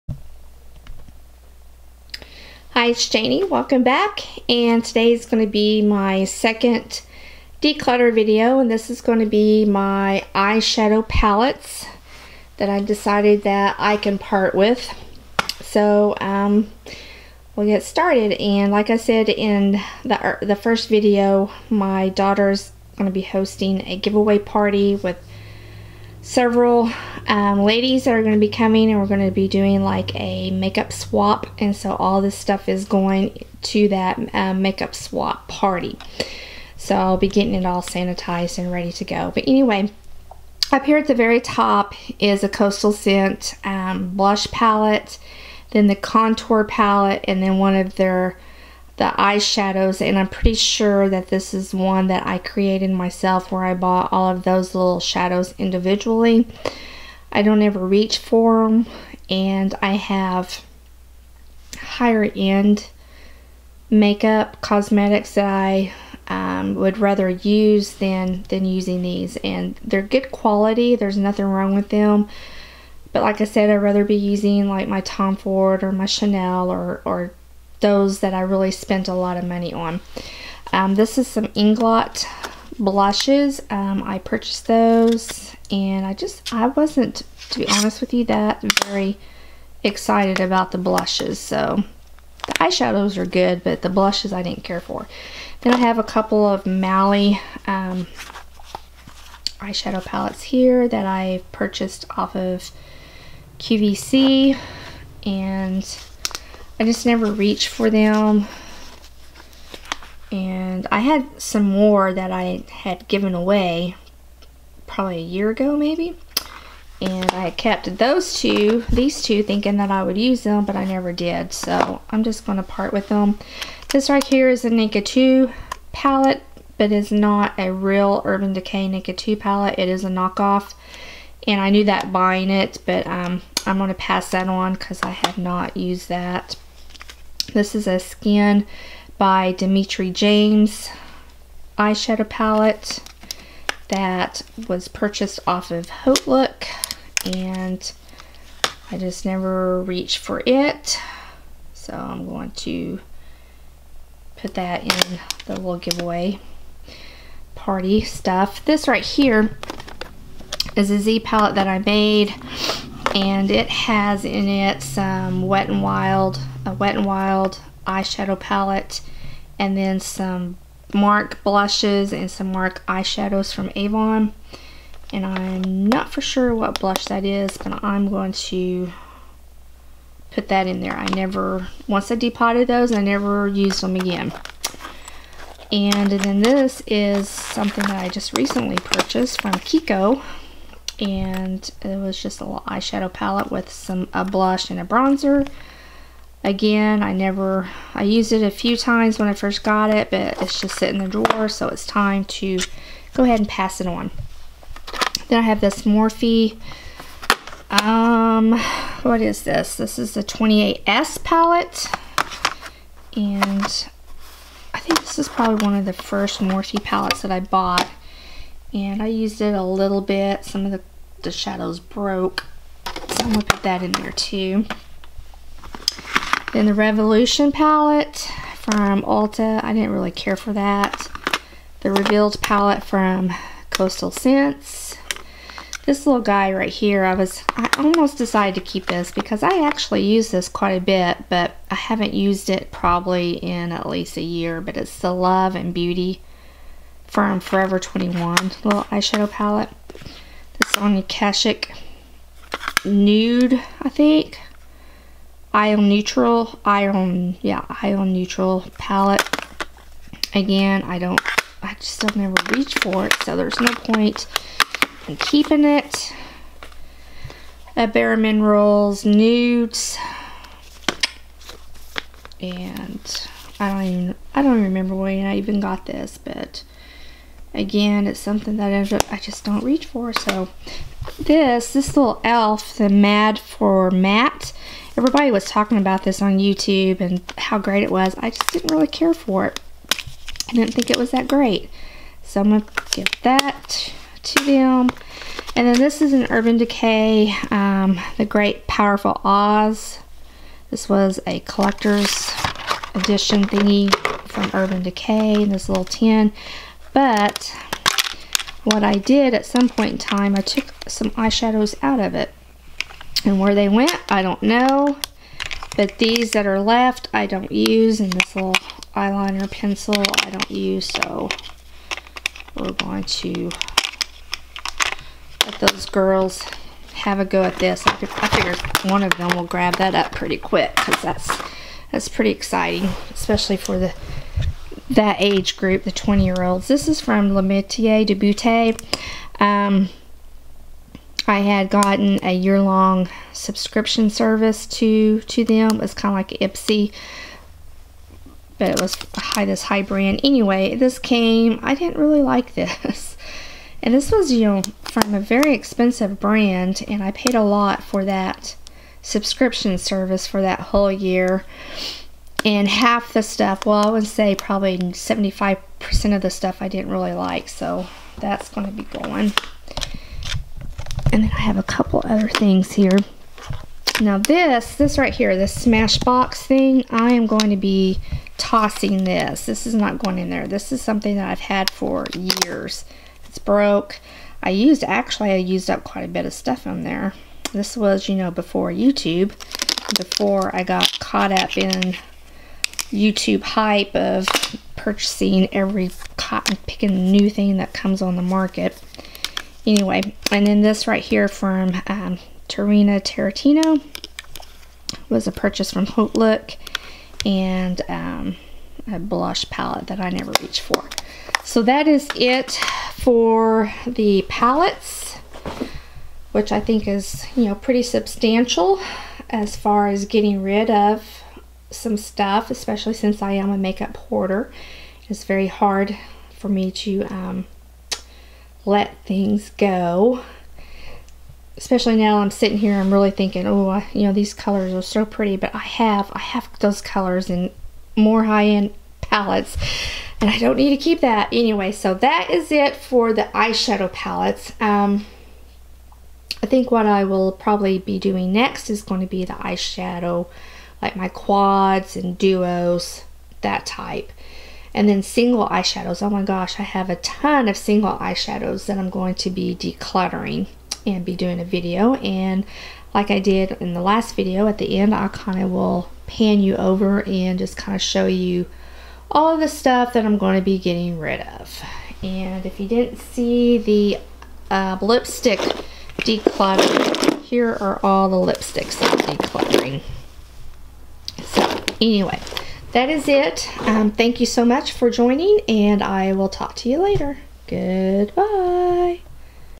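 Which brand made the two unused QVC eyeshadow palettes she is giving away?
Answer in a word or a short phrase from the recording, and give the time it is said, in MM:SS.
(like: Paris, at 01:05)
Mally, at 01:36.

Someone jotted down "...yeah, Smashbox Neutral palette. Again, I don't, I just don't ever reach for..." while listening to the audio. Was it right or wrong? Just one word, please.
wrong.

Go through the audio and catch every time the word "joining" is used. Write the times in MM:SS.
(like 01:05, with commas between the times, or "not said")
08:04.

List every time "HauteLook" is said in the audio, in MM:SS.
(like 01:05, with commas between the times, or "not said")
02:25, 06:45.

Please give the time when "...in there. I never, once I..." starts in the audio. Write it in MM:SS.
03:00.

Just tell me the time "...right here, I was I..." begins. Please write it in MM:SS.
03:56.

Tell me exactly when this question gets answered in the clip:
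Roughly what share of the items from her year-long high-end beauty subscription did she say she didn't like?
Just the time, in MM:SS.
06:04.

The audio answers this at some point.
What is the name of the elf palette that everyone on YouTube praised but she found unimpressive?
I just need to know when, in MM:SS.
04:42.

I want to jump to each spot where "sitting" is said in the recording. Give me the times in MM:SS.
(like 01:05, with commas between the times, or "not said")
03:20, 07:12.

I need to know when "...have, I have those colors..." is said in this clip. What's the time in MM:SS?
07:15.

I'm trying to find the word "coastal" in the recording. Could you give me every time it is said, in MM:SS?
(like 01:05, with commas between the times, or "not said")
00:42, 03:53.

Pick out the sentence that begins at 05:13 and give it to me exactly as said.
And where they went, I don't know.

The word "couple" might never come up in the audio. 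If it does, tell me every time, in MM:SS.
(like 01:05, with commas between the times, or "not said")
01:36, 06:11.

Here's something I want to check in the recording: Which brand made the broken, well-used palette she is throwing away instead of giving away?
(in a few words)
Smashbox.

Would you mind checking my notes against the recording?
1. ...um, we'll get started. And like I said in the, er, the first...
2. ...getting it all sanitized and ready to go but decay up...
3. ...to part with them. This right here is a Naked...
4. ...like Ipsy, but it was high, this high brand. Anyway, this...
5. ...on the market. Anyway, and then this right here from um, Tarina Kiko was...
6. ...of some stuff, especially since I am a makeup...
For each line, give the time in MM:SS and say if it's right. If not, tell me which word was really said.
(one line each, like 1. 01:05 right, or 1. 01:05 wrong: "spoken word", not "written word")
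1. 00:16 right
2. 00:37 wrong: "anyway", not "decay"
3. 02:02 right
4. 05:46 right
5. 06:38 wrong: "Tarantino", not "Kiko"
6. 07:00 right.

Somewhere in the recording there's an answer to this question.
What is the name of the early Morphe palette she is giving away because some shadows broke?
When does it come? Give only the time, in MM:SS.
03:30.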